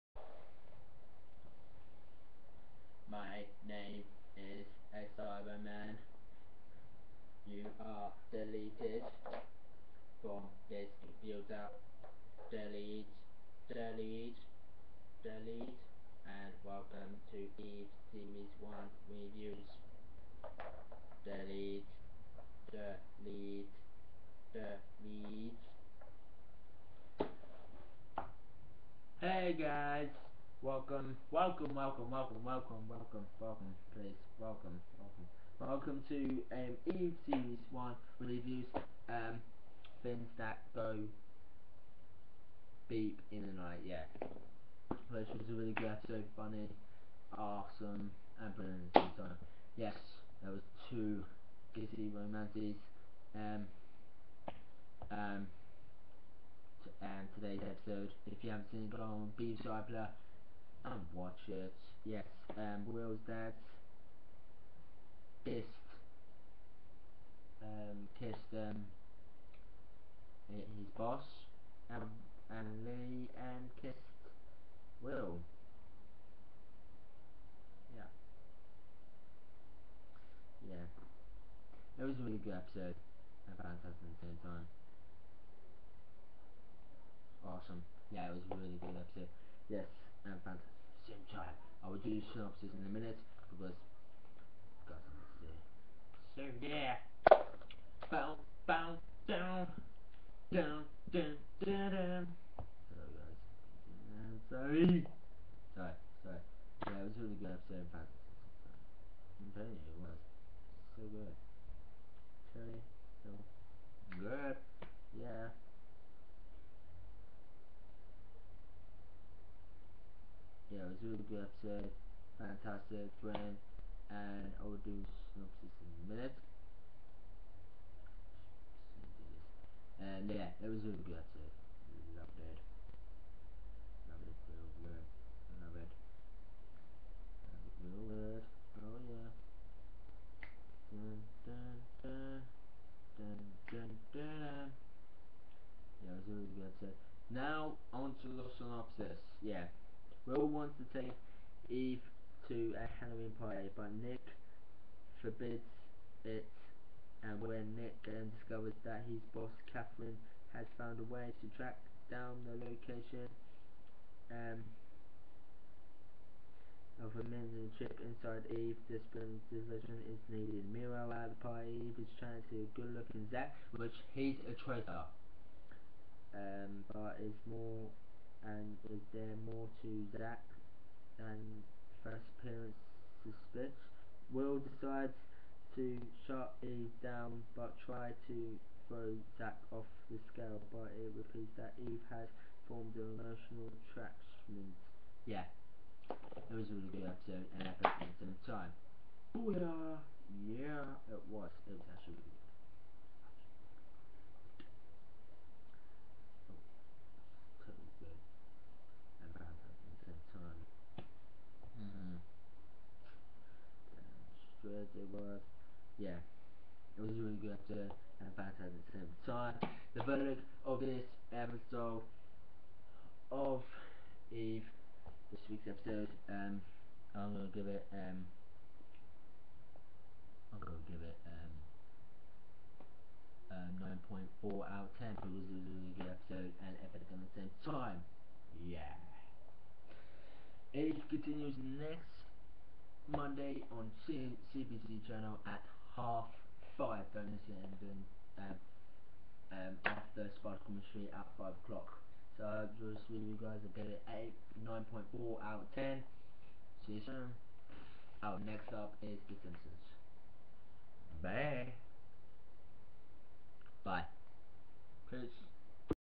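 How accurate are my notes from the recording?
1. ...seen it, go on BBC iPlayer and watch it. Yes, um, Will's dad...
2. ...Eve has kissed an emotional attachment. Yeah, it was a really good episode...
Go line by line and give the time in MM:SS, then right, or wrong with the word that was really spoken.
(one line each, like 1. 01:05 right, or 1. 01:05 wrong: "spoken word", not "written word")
1. 00:58 right
2. 03:11 wrong: "formed", not "kissed".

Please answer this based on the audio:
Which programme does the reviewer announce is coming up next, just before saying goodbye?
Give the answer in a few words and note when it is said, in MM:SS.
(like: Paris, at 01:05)
The Simpsons, at 04:19.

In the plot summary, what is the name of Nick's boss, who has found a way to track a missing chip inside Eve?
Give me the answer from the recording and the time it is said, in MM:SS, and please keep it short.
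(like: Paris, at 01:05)
Katherine, at 02:39.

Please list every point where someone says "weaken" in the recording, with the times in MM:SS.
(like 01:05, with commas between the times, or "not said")
not said.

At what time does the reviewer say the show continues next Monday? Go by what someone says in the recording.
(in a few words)
half five.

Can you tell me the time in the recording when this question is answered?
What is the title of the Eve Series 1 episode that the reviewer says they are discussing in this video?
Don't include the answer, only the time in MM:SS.
00:40.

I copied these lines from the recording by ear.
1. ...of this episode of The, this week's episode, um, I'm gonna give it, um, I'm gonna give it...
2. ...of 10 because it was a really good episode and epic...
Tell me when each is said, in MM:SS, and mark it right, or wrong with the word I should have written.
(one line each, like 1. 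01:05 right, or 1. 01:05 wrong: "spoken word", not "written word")
1. 03:40 wrong: "Eve", not "The"
2. 03:54 right.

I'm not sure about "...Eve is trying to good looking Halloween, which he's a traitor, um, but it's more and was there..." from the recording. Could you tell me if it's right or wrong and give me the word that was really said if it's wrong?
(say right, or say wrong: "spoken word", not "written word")
wrong: "Zac", not "Halloween".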